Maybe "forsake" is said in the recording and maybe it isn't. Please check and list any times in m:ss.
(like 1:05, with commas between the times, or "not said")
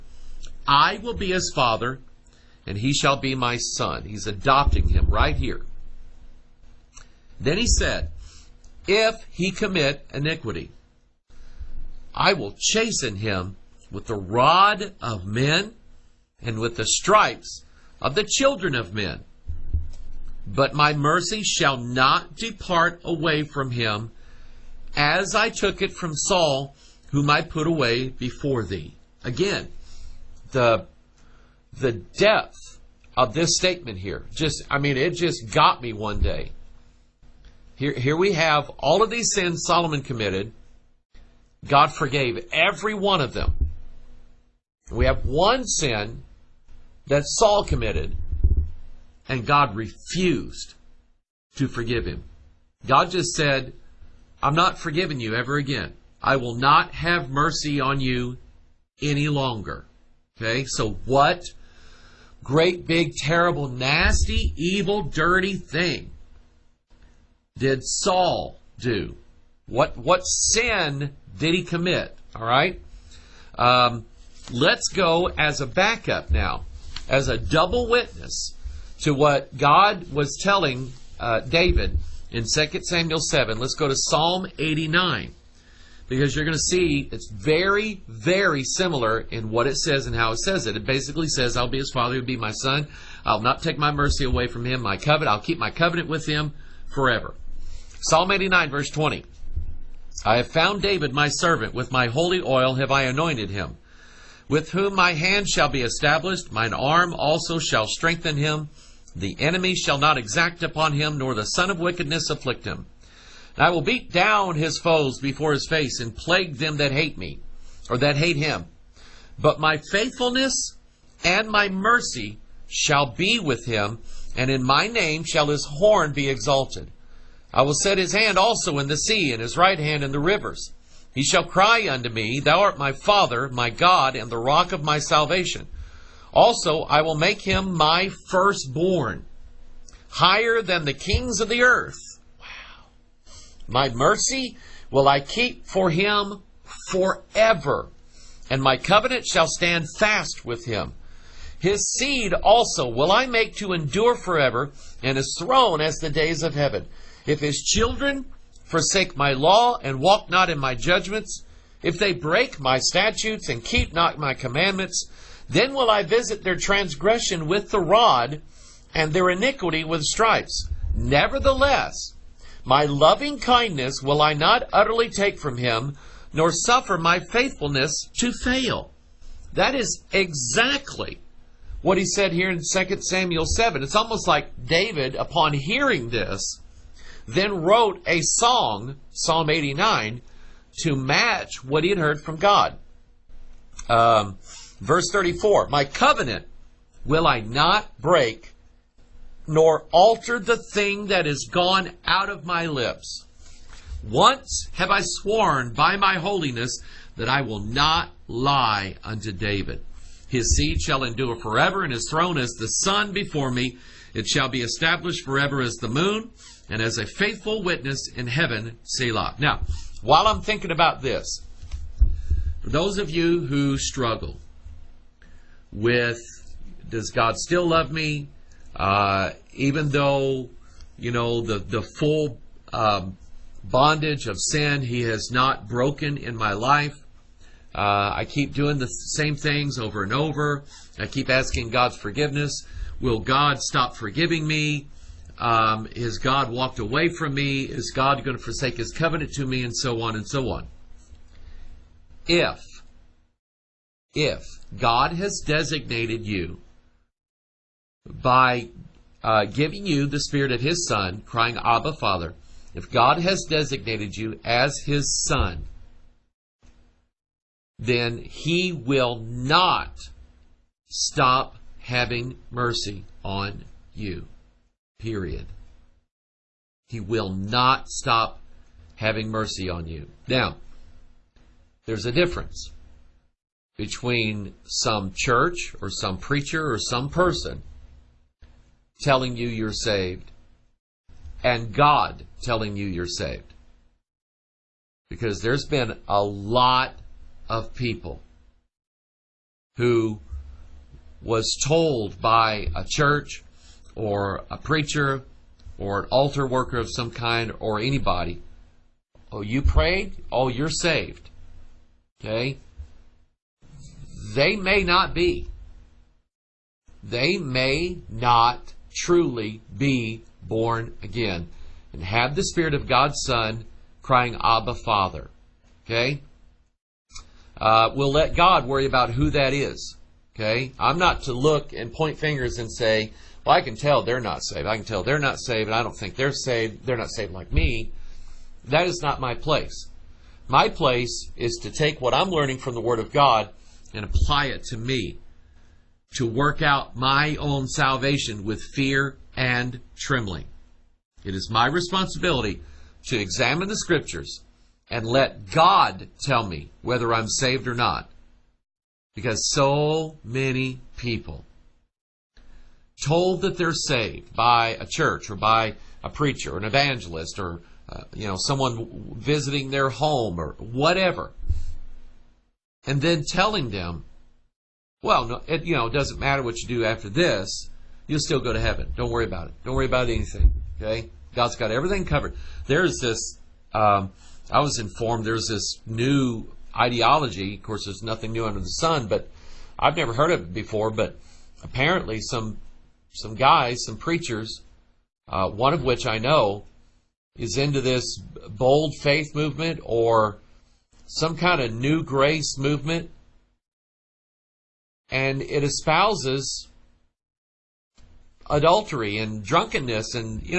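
2:38, 4:08.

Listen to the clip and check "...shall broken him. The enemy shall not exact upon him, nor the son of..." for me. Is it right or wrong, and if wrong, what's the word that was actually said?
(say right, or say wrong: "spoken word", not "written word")
wrong: "strengthen", not "broken".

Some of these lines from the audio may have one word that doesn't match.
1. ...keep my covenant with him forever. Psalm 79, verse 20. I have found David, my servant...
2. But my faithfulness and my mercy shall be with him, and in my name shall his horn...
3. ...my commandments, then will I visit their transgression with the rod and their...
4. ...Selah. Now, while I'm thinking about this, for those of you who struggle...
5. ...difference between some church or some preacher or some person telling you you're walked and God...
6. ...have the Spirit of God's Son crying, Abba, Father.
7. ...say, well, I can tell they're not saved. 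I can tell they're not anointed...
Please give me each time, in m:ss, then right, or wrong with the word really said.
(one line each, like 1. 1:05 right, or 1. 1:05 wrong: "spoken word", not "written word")
1. 1:35 wrong: "89", not "79"
2. 1:59 right
3. 2:44 right
4. 3:38 right
5. 4:42 wrong: "saved", not "walked"
6. 5:22 right
7. 5:32 wrong: "saved", not "anointed".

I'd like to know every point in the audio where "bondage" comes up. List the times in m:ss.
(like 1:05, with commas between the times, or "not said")
3:53.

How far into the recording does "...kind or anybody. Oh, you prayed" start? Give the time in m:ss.
5:07.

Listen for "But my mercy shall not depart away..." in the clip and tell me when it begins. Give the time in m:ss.
0:20.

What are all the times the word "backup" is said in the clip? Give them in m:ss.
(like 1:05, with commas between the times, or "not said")
1:15.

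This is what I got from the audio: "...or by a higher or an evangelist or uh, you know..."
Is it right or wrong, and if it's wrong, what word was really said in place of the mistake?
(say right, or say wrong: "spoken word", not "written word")
wrong: "preacher", not "higher".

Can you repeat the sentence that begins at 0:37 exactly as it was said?
Here here we have all of these sins Solomon committed.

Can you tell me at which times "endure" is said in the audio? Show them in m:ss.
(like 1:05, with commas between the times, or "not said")
2:33, 3:31.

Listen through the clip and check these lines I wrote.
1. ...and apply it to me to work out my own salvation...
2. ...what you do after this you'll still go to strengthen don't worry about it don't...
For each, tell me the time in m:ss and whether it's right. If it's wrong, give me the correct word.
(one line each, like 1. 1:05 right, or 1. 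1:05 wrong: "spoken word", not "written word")
1. 5:43 right
2. 6:16 wrong: "heaven", not "strengthen".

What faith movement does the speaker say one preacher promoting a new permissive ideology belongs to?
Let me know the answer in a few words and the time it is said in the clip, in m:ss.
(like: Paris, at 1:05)
bold faith movement, at 6:38.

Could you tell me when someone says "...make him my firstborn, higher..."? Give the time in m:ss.
2:17.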